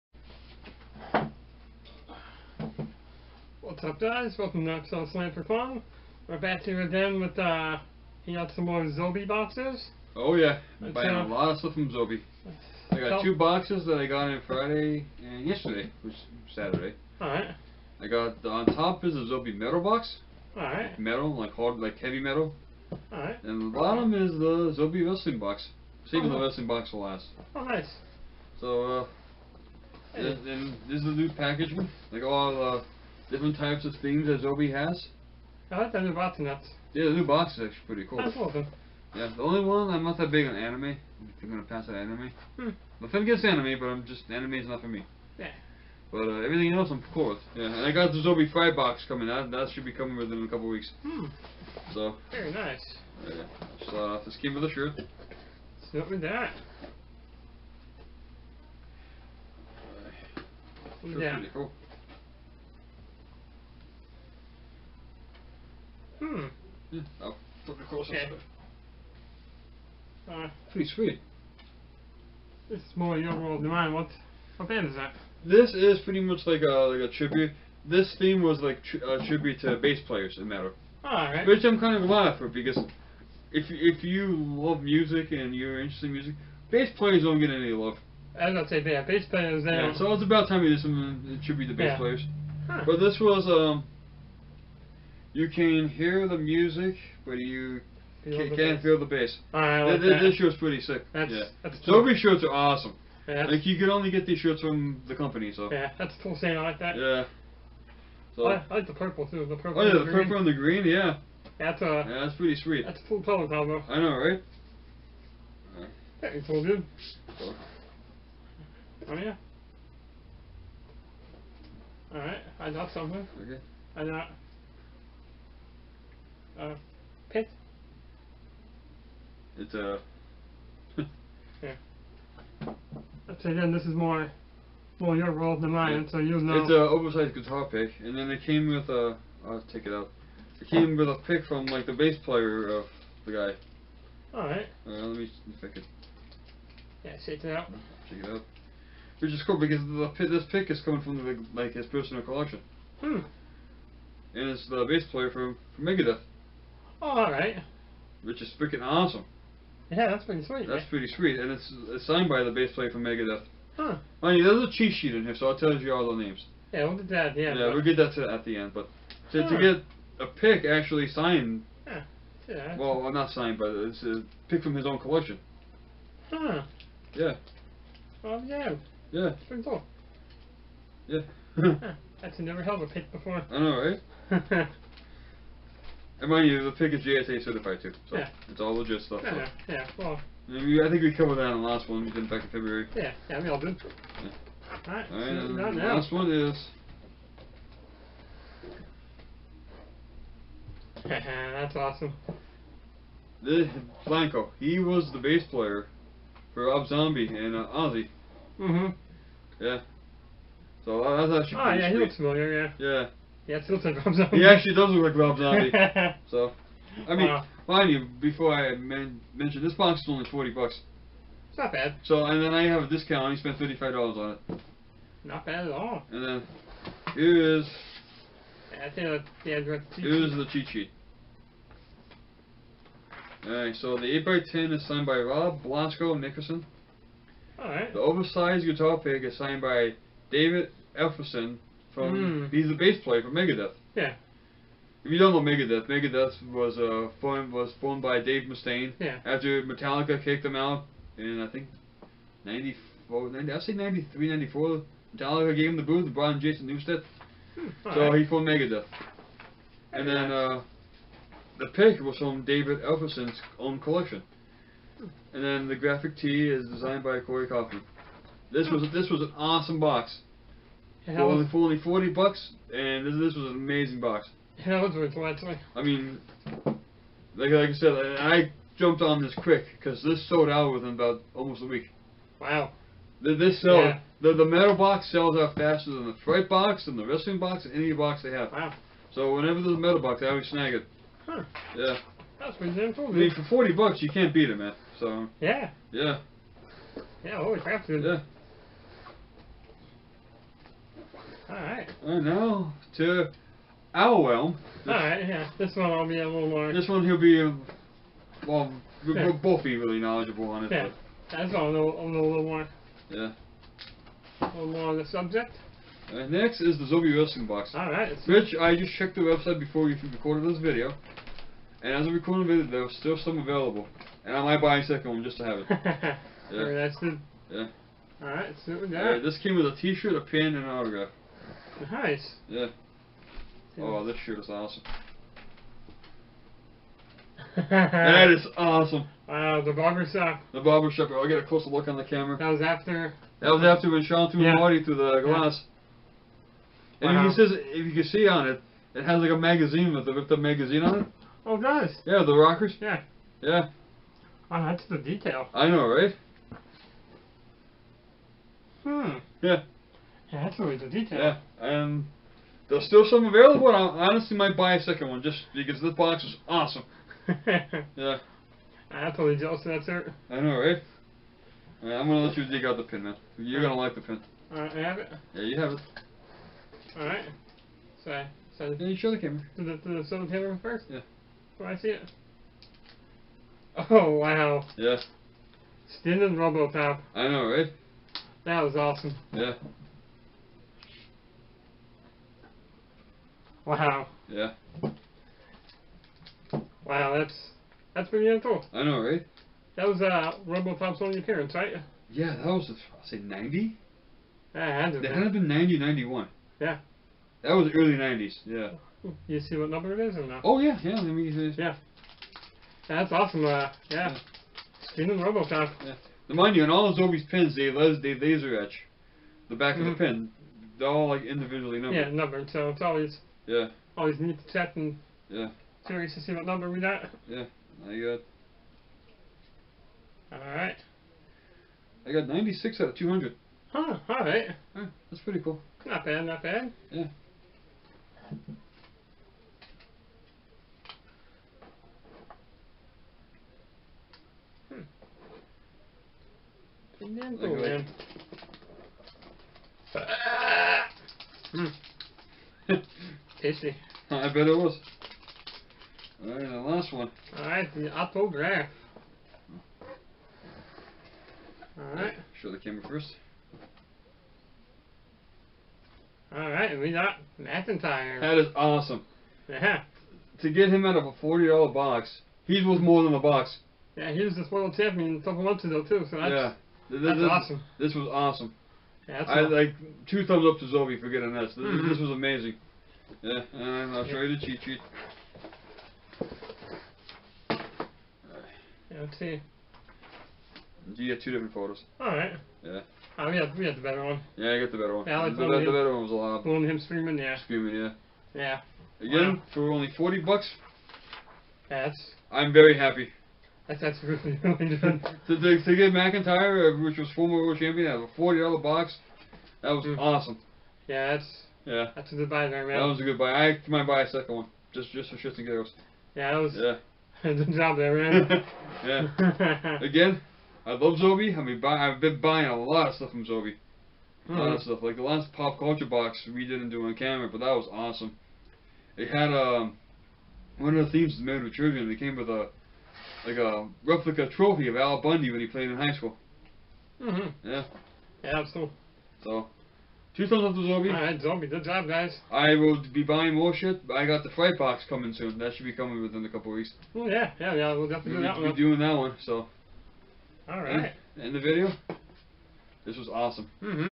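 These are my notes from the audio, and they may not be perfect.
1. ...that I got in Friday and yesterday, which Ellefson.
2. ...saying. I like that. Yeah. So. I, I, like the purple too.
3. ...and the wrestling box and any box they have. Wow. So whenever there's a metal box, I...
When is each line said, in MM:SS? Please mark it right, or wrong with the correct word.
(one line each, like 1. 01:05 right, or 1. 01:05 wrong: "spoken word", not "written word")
1. 00:13 wrong: "Saturday", not "Ellefson"
2. 01:46 right
3. 04:46 right.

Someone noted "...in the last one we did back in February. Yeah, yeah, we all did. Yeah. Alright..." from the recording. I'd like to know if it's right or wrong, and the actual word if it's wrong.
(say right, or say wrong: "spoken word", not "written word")
right.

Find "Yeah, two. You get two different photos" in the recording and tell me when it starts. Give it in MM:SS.
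08:08.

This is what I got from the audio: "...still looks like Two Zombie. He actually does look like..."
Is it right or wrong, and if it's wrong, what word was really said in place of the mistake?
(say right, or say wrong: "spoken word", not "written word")
wrong: "Rob", not "Two".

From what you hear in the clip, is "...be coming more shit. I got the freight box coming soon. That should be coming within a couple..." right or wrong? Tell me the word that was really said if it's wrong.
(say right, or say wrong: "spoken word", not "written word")
wrong: "buying", not "coming".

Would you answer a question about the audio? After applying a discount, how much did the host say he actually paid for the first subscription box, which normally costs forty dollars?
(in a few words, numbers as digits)
$35.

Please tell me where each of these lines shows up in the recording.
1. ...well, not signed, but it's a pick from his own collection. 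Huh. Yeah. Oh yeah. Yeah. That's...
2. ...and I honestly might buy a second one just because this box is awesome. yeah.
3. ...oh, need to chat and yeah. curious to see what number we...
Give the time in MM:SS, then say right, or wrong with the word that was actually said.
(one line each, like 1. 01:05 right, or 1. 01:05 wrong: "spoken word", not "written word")
1. 02:52 right
2. 06:03 right
3. 07:04 right.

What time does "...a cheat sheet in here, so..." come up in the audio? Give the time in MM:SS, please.
02:44.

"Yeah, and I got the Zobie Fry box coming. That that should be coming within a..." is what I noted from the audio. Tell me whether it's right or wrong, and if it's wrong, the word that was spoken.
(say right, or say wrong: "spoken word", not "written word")
right.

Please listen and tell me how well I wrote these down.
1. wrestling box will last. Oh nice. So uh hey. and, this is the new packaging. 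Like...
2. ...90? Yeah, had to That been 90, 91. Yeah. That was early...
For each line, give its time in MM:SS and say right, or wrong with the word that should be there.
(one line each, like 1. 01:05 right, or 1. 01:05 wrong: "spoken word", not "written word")
1. 00:26 right
2. 06:43 right.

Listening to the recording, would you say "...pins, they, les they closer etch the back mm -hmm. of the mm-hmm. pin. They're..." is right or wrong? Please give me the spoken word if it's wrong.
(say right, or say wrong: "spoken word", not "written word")
wrong: "laser", not "closer".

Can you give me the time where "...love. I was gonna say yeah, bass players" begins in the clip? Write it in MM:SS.
01:27.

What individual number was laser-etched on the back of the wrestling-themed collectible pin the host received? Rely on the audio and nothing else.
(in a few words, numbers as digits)
96.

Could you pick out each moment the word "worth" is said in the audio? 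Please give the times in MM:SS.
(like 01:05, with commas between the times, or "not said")
04:34, 07:52.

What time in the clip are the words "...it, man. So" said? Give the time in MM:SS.
04:54.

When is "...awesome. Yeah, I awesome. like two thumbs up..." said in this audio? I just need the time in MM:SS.
07:58.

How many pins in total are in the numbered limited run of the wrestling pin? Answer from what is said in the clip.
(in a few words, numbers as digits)
200.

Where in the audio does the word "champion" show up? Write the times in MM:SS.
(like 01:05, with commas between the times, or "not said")
07:54, 08:27.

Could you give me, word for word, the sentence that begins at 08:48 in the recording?
It had um, one of the themes made with Trivium.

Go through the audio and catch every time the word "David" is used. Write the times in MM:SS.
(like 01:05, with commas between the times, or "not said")
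04:00, 04:22.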